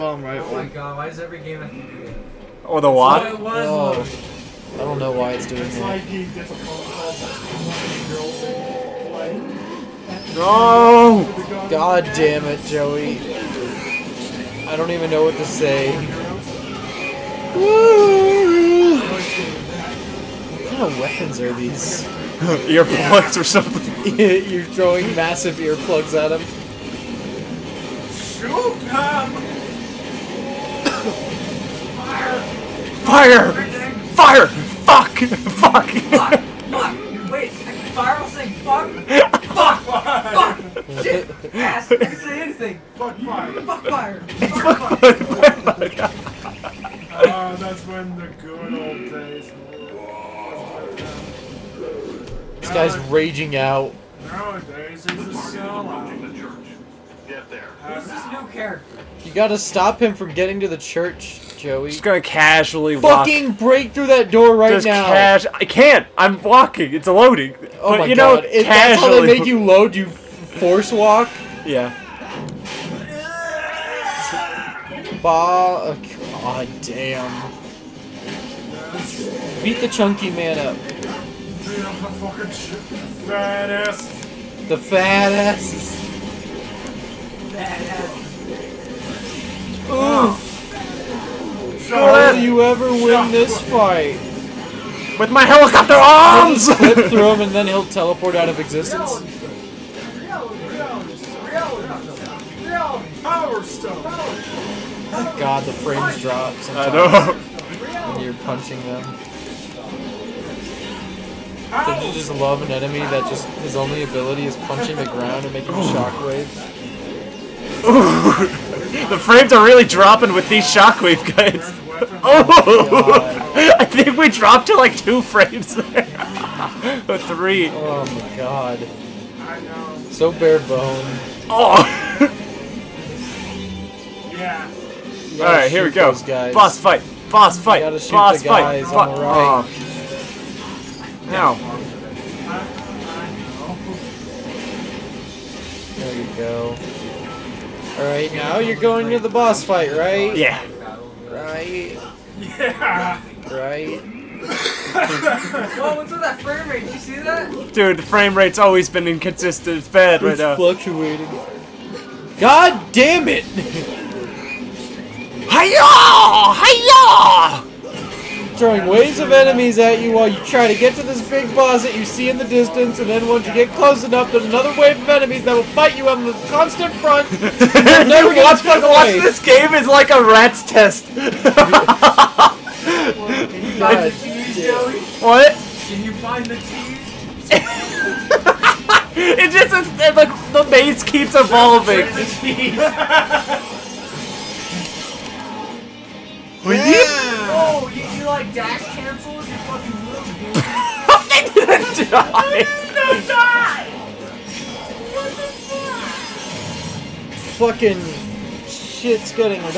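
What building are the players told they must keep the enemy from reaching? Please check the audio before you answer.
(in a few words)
The church.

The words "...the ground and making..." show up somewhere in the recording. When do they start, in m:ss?
1:54.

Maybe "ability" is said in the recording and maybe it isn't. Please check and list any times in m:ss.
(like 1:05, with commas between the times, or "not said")
1:54.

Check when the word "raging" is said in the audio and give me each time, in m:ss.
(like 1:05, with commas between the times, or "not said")
0:53.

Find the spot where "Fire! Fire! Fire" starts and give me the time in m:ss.
0:33.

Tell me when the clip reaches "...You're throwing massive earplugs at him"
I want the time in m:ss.
0:24.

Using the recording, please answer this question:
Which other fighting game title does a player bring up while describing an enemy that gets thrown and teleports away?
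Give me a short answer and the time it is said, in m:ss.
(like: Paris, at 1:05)
Power Stone, at 1:43.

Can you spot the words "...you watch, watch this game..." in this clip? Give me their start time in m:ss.
2:58.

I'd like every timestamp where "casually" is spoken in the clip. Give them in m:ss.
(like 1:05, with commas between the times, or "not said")
1:02, 1:08.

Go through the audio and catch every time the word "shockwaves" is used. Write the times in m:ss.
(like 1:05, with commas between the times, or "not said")
1:55, 2:00.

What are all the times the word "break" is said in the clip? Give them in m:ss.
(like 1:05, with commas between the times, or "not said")
1:03.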